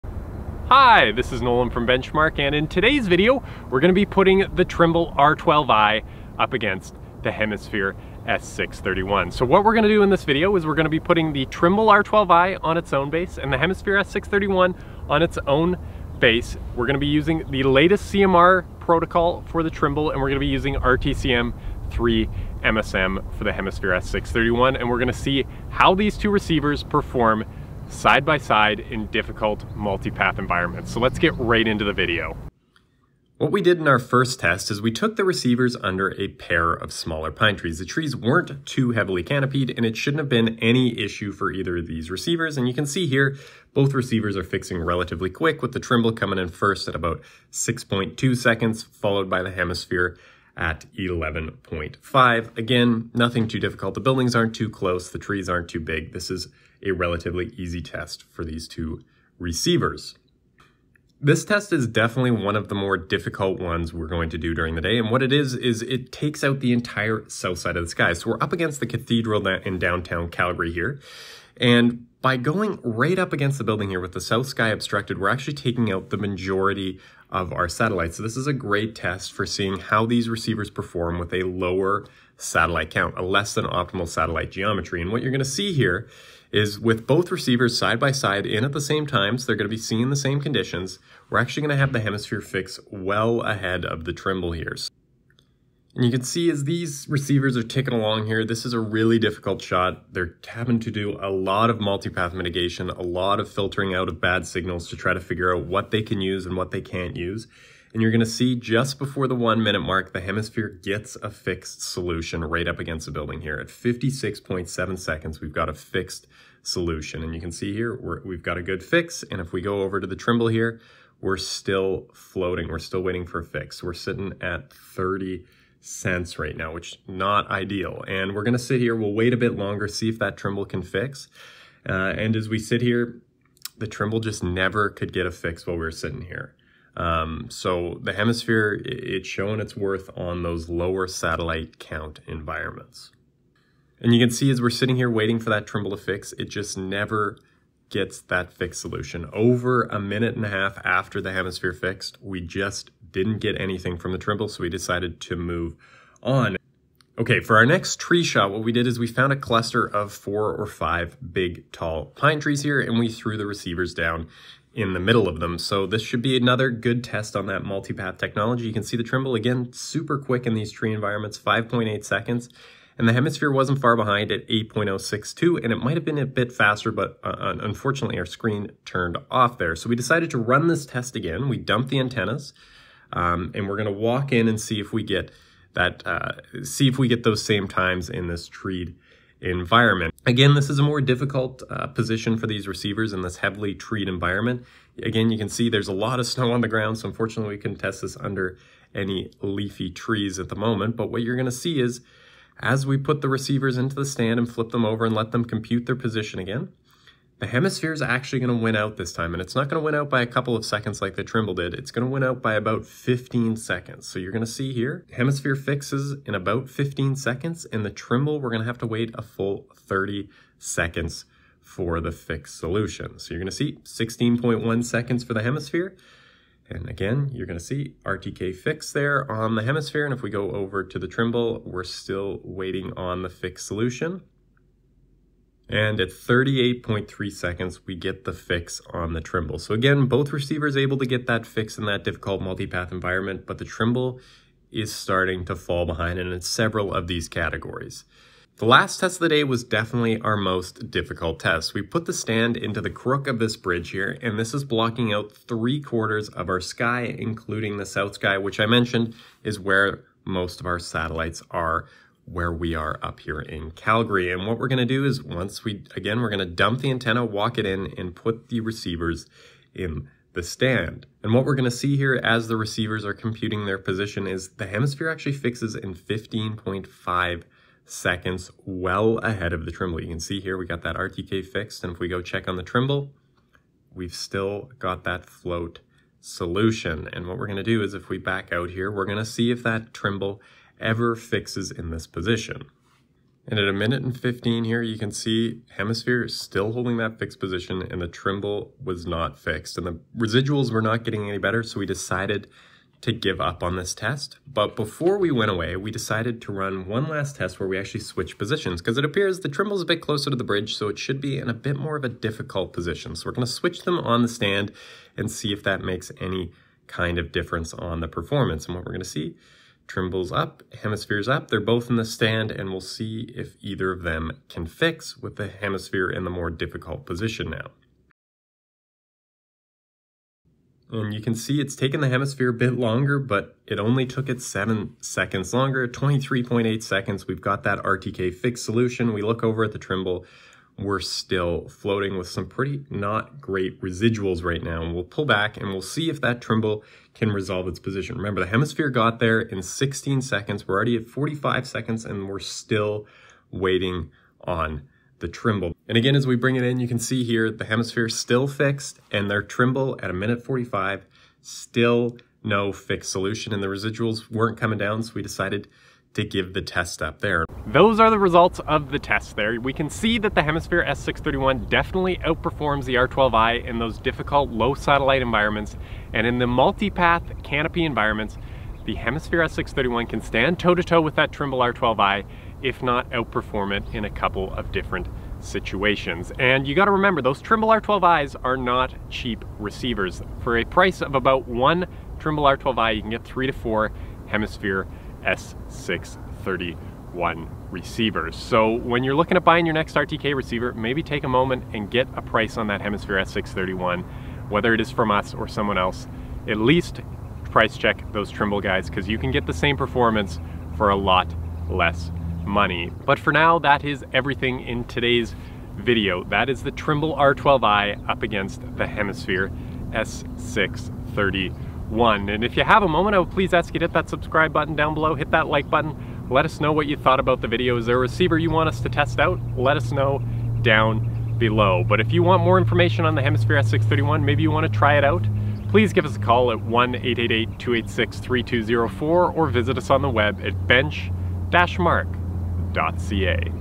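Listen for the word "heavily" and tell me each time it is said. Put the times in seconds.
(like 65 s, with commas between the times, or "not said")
38 s, 193 s.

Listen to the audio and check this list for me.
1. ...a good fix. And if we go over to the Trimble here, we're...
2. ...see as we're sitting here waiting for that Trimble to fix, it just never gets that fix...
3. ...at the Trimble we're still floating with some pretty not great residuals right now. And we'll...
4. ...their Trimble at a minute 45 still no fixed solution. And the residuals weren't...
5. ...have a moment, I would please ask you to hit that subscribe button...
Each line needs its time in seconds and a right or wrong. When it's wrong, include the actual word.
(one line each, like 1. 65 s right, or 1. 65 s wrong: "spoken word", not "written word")
1. 118 s right
2. 144 s right
3. 339 s right
4. 359 s right
5. 422 s right.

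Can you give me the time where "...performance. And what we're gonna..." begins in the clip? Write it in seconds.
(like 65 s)
318 s.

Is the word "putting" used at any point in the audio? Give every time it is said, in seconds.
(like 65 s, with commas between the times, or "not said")
4 s, 11 s.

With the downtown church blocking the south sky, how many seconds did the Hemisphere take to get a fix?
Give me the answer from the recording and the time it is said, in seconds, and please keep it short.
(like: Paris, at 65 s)
56.7, at 113 s.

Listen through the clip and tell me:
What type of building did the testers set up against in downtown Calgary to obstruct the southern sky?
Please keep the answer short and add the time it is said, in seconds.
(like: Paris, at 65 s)
cathedral, at 68 s.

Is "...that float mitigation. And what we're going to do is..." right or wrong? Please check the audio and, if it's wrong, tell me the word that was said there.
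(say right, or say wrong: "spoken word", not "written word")
wrong: "solution", not "mitigation".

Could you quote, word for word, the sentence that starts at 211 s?
It's going to win out by about 15 seconds.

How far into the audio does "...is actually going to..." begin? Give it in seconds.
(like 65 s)
207 s.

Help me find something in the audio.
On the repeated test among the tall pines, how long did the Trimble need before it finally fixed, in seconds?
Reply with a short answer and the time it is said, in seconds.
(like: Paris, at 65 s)
38.3, at 236 s.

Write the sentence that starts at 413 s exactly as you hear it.
But for now, that is everything in today's video.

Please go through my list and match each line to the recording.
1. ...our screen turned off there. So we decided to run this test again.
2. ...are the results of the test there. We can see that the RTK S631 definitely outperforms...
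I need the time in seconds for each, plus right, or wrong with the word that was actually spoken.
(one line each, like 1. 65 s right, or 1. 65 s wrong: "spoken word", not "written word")
1. 178 s right
2. 367 s wrong: "Hemisphere", not "RTK".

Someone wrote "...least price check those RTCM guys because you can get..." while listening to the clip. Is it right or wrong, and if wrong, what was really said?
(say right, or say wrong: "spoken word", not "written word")
wrong: "Trimble", not "RTCM".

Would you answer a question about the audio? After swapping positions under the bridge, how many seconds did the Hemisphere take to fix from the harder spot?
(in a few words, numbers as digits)
23.8.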